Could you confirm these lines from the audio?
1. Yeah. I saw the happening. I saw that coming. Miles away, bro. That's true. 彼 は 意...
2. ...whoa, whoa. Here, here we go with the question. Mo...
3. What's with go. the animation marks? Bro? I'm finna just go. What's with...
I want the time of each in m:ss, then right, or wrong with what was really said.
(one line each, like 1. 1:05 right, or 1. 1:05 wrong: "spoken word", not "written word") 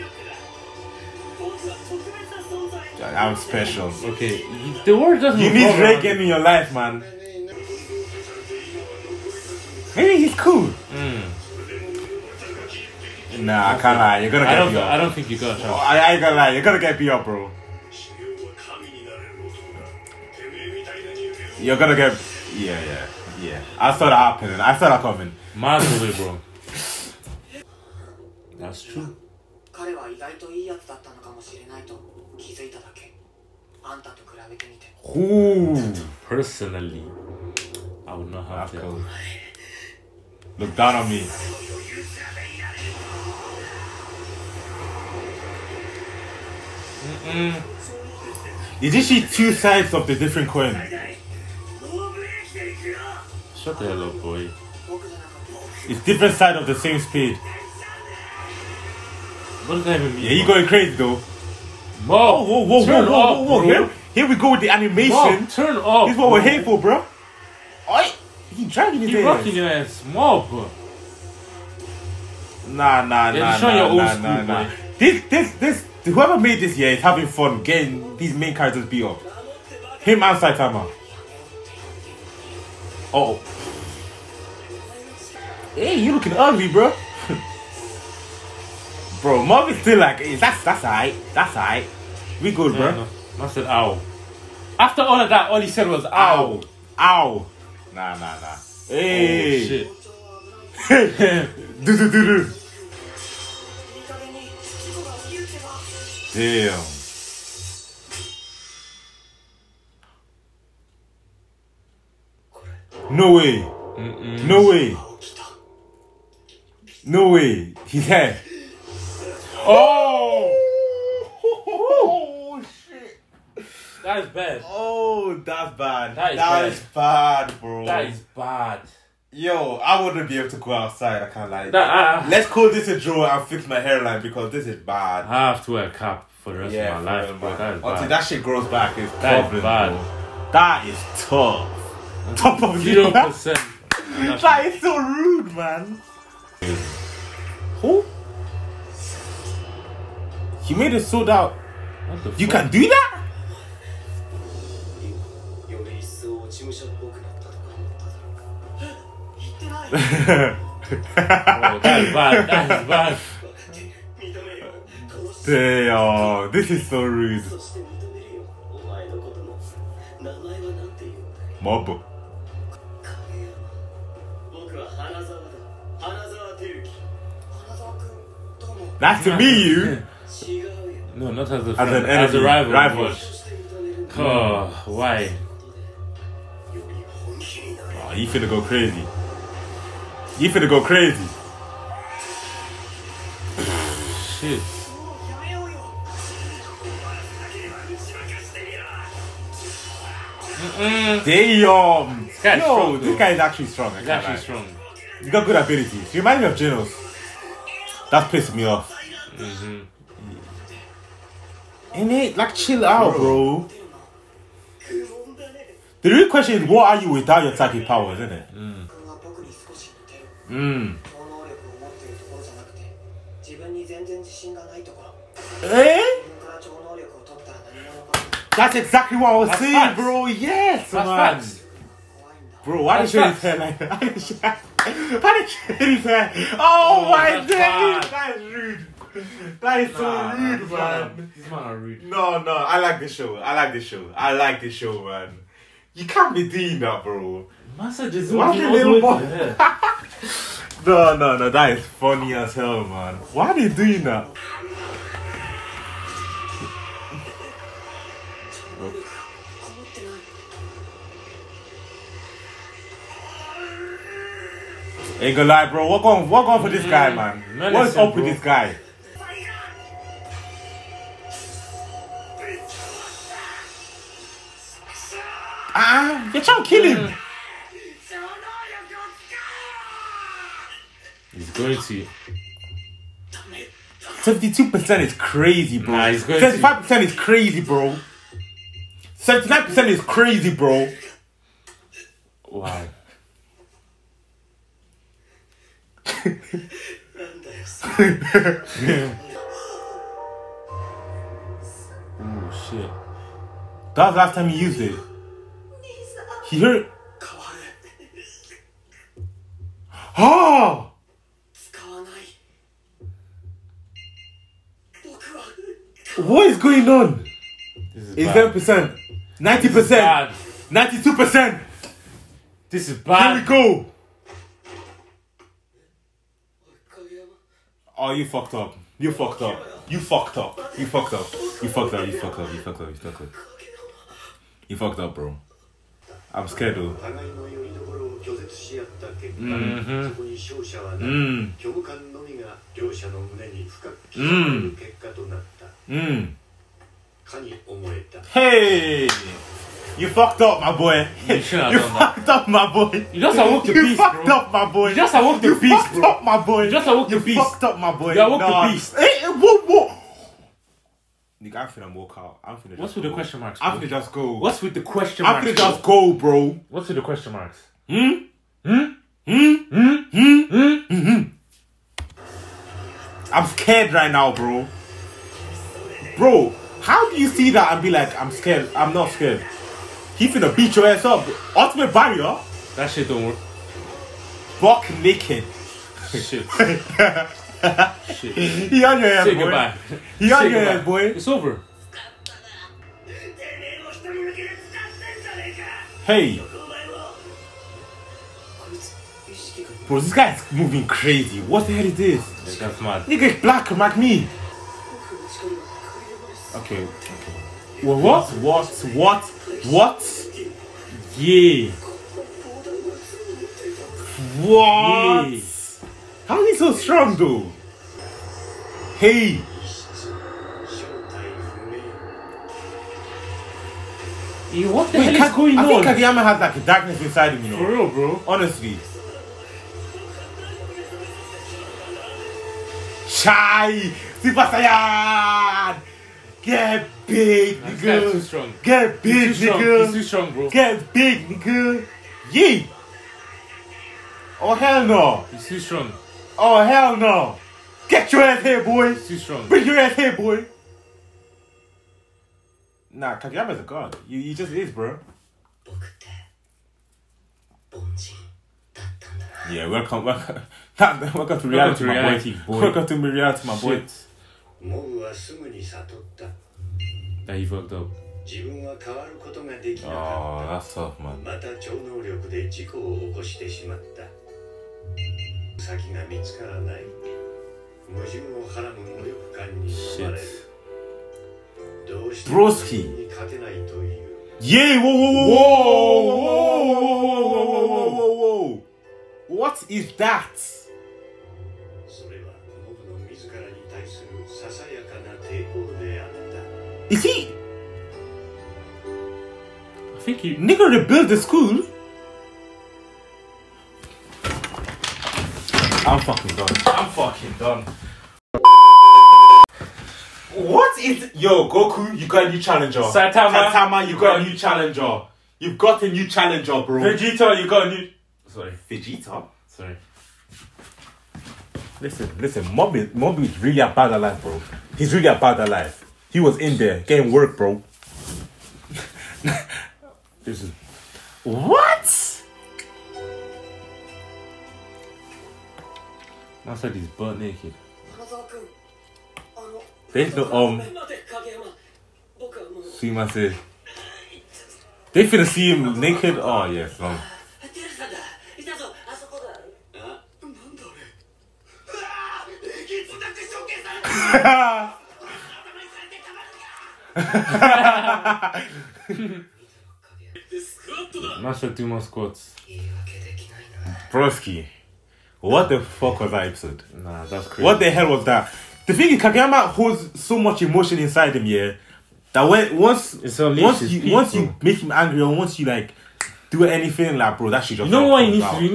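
1. 0:23 right
2. 1:03 wrong: "animation", not "question"
3. 6:02 wrong: "question", not "animation".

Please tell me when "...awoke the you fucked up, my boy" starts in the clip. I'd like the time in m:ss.
5:55.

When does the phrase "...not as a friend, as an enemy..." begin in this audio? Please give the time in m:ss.
3:01.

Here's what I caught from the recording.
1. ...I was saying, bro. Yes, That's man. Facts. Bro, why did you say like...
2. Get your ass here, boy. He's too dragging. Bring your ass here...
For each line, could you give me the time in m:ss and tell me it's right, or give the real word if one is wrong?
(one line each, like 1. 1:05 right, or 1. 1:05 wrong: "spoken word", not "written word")
1. 3:49 right
2. 7:27 wrong: "strong", not "dragging".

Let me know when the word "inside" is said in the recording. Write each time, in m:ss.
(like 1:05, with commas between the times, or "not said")
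7:07, 9:30.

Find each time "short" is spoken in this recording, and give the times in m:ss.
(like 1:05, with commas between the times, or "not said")
not said.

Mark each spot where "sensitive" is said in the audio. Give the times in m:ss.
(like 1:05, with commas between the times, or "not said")
not said.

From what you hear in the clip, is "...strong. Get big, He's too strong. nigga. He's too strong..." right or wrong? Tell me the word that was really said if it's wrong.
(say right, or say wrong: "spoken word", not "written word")
right.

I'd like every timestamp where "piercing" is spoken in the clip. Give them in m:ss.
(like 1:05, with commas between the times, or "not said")
not said.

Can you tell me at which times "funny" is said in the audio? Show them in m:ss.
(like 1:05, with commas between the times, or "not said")
4:11.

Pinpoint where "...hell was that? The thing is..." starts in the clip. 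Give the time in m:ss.
9:27.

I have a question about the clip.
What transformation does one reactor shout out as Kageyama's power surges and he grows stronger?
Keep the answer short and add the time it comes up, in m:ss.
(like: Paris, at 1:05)
Super Saiyan, at 7:14.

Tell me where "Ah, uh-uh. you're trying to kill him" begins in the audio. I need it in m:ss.
4:35.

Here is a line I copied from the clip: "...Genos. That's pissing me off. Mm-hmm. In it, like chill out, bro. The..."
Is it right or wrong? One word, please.
right.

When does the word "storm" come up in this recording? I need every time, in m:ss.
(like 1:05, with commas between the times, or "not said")
not said.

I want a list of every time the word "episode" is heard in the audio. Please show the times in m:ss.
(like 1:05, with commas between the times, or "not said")
9:26.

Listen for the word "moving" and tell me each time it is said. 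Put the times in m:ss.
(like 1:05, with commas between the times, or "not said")
6:40.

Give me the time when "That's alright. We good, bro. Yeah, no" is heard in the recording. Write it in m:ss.
1:31.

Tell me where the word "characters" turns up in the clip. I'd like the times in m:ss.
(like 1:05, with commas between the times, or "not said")
1:18.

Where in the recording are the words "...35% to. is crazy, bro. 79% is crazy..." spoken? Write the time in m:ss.
4:46.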